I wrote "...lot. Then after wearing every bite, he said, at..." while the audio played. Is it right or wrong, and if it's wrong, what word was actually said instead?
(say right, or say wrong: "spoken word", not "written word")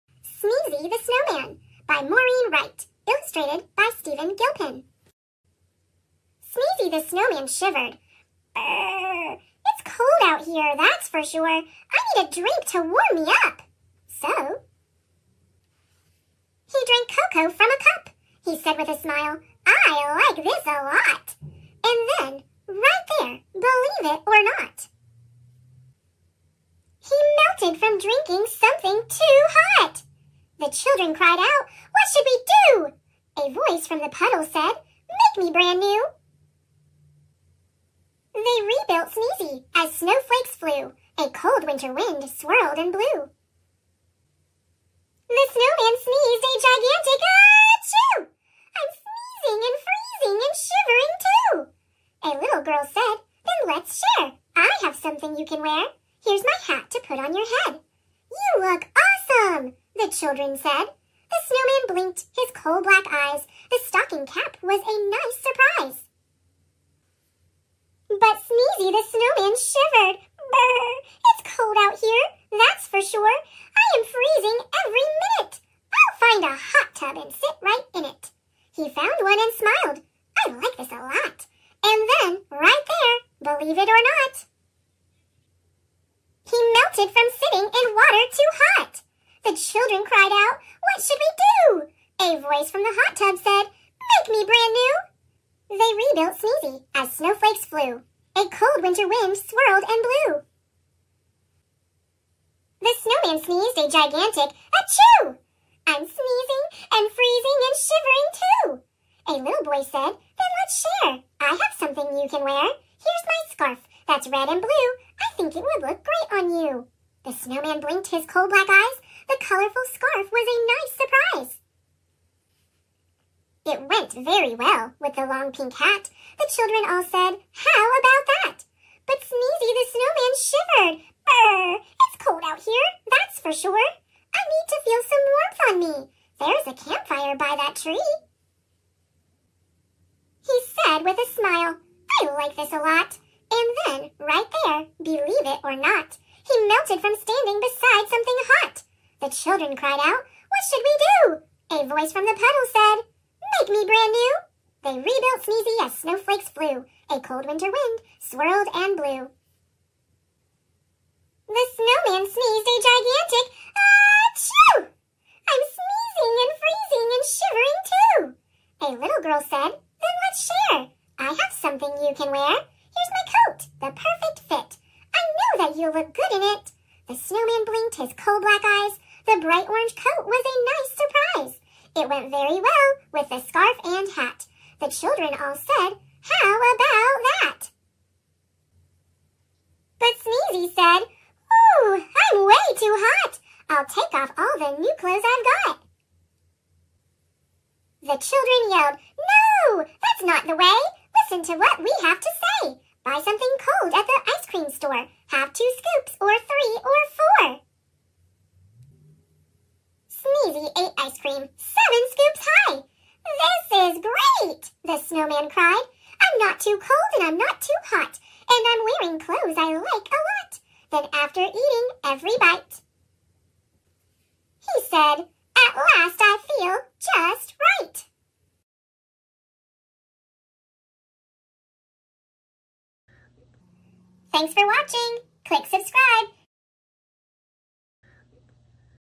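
wrong: "eating", not "wearing".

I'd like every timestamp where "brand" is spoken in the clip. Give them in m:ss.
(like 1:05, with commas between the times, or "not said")
0:35, 1:34, 2:33.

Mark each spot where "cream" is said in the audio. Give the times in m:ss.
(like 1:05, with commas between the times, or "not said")
3:24, 3:31.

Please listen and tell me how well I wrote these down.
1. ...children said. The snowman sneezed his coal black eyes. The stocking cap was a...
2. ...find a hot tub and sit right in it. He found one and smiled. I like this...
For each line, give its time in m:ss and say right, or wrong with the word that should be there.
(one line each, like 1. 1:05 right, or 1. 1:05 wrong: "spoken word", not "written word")
1. 1:00 wrong: "blinked", not "sneezed"
2. 1:16 right.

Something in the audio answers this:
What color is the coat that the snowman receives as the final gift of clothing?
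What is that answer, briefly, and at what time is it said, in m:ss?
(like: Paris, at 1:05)
Orange, at 2:59.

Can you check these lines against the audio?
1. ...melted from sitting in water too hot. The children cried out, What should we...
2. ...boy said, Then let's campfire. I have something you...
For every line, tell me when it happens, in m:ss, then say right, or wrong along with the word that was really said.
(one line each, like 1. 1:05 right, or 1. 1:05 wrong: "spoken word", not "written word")
1. 1:26 right
2. 1:49 wrong: "share", not "campfire".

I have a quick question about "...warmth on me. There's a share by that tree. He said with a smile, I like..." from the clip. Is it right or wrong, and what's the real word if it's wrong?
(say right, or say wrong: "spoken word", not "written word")
wrong: "campfire", not "share".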